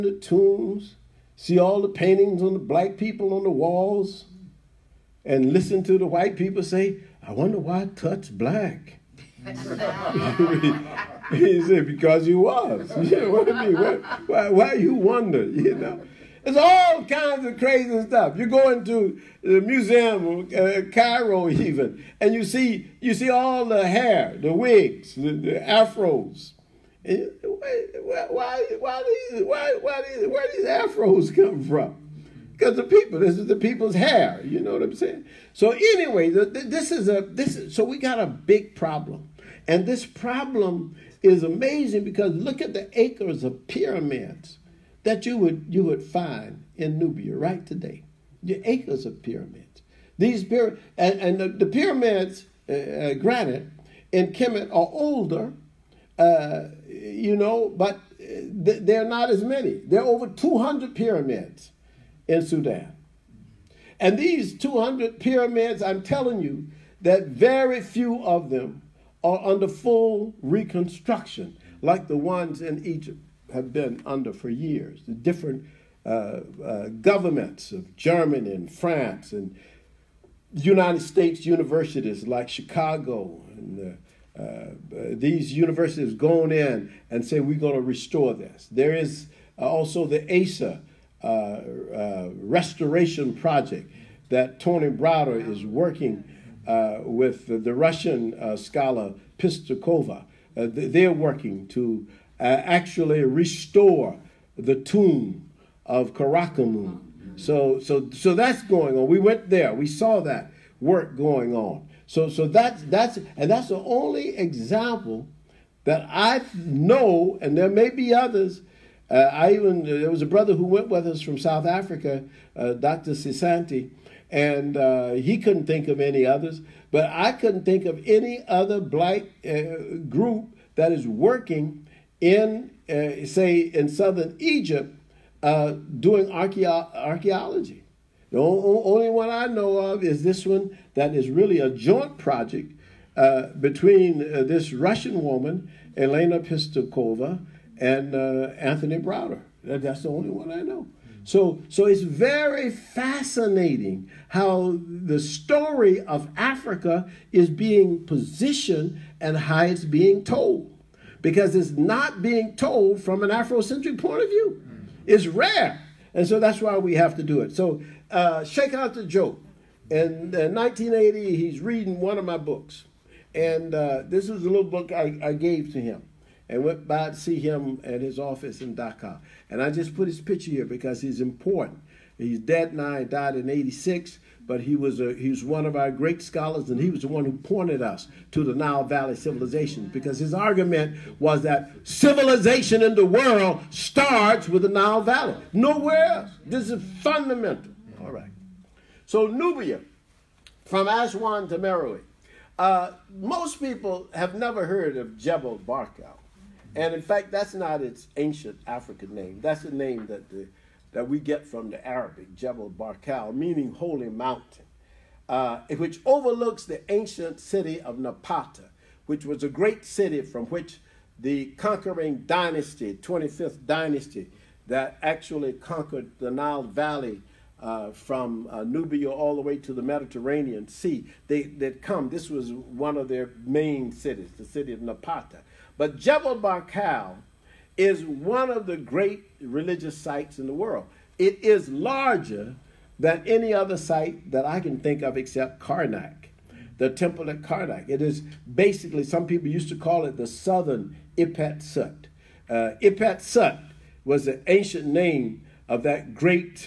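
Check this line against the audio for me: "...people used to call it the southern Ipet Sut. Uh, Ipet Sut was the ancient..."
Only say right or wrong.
right.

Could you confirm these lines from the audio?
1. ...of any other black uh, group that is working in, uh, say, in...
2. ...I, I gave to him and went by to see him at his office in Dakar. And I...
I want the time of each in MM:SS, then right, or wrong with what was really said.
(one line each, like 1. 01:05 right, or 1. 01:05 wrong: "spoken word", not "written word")
1. 02:07 right
2. 02:54 right.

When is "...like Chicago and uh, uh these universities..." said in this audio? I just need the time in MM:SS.
01:22.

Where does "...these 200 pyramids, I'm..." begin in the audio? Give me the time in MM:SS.
01:04.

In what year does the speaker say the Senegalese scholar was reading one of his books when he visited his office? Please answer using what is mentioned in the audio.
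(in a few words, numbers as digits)
1980.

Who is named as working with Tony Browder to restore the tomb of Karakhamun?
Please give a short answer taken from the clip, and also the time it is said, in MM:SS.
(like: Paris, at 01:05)
Elena Pischikova, at 02:25.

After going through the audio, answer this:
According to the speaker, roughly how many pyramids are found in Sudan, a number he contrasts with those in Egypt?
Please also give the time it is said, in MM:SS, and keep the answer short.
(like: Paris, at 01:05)
over 200, at 01:00.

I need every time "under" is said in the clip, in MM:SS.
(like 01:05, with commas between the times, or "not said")
01:09, 01:14.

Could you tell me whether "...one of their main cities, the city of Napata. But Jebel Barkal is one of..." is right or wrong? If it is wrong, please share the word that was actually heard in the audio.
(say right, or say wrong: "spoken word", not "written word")
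right.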